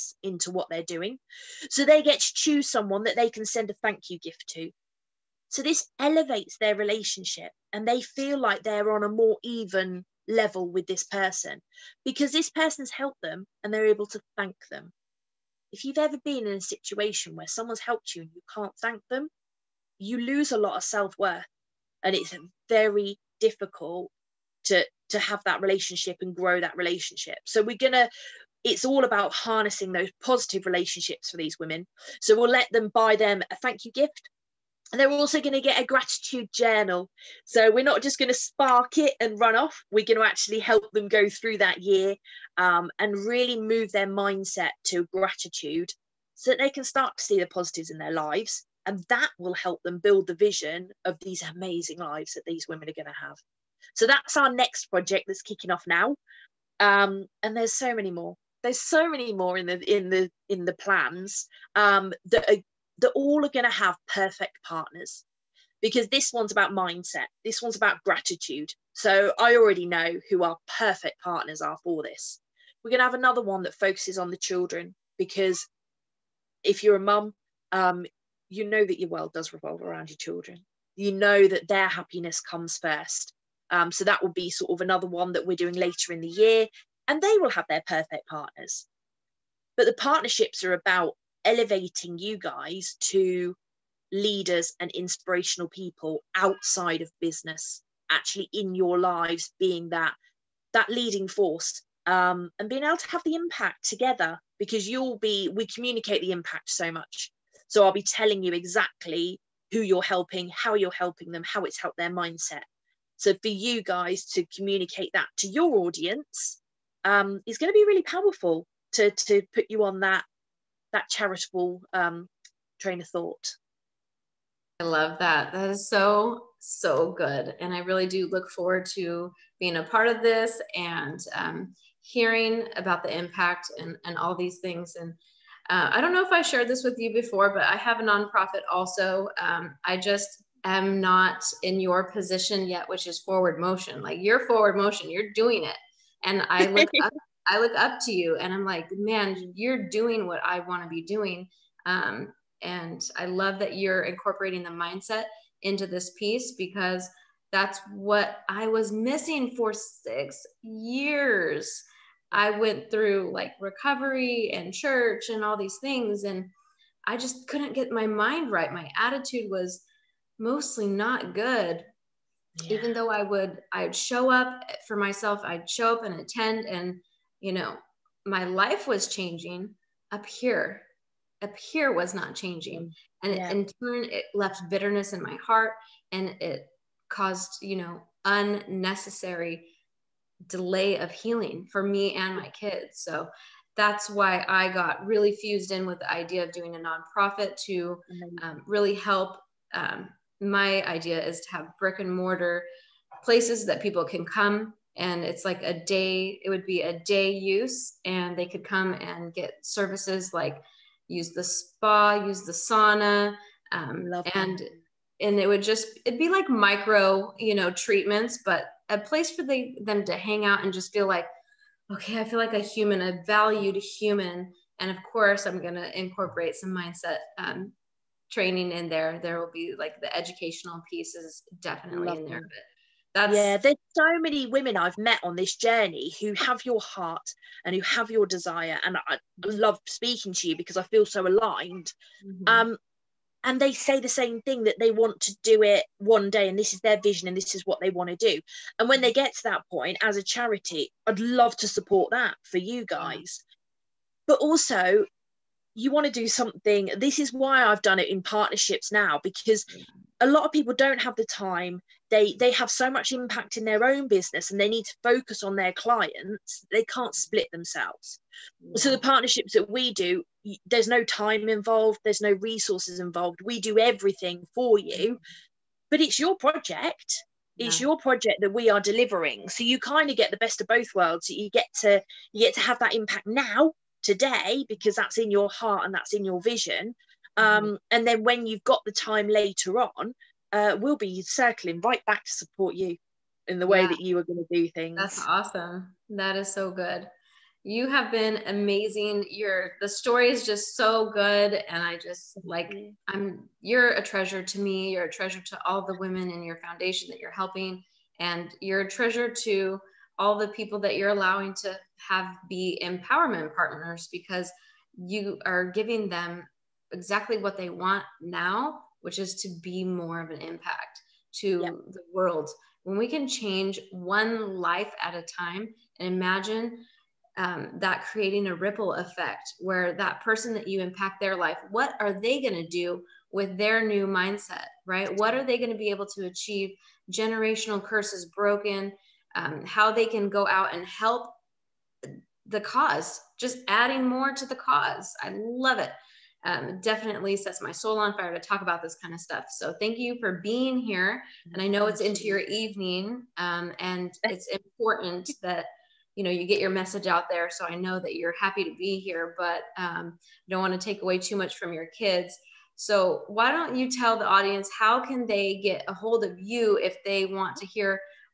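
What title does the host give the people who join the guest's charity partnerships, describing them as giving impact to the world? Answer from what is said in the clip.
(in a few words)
empowerment partners.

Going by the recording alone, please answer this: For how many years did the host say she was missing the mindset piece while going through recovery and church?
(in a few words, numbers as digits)
6.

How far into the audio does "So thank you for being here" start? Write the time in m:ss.
5:49.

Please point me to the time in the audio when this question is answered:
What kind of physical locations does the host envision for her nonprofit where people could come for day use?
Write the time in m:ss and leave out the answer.
3:21.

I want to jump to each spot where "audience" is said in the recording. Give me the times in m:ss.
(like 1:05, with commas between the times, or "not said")
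1:55, 6:04.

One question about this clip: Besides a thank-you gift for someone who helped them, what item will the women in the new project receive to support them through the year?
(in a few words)
gratitude journal.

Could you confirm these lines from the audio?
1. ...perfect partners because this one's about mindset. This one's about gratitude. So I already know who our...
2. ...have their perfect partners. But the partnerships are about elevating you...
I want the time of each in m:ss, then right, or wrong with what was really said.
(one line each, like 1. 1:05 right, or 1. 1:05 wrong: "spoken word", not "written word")
1. 1:04 right
2. 1:27 right.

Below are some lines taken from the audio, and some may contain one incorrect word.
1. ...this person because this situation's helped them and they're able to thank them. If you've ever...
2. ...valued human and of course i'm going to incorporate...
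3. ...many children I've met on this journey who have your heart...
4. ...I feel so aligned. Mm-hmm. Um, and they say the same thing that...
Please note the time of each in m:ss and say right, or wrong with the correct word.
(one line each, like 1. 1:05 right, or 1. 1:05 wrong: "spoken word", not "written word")
1. 0:10 wrong: "person", not "situation"
2. 3:43 right
3. 3:54 wrong: "women", not "children"
4. 4:00 right.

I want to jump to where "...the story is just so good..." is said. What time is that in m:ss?
4:59.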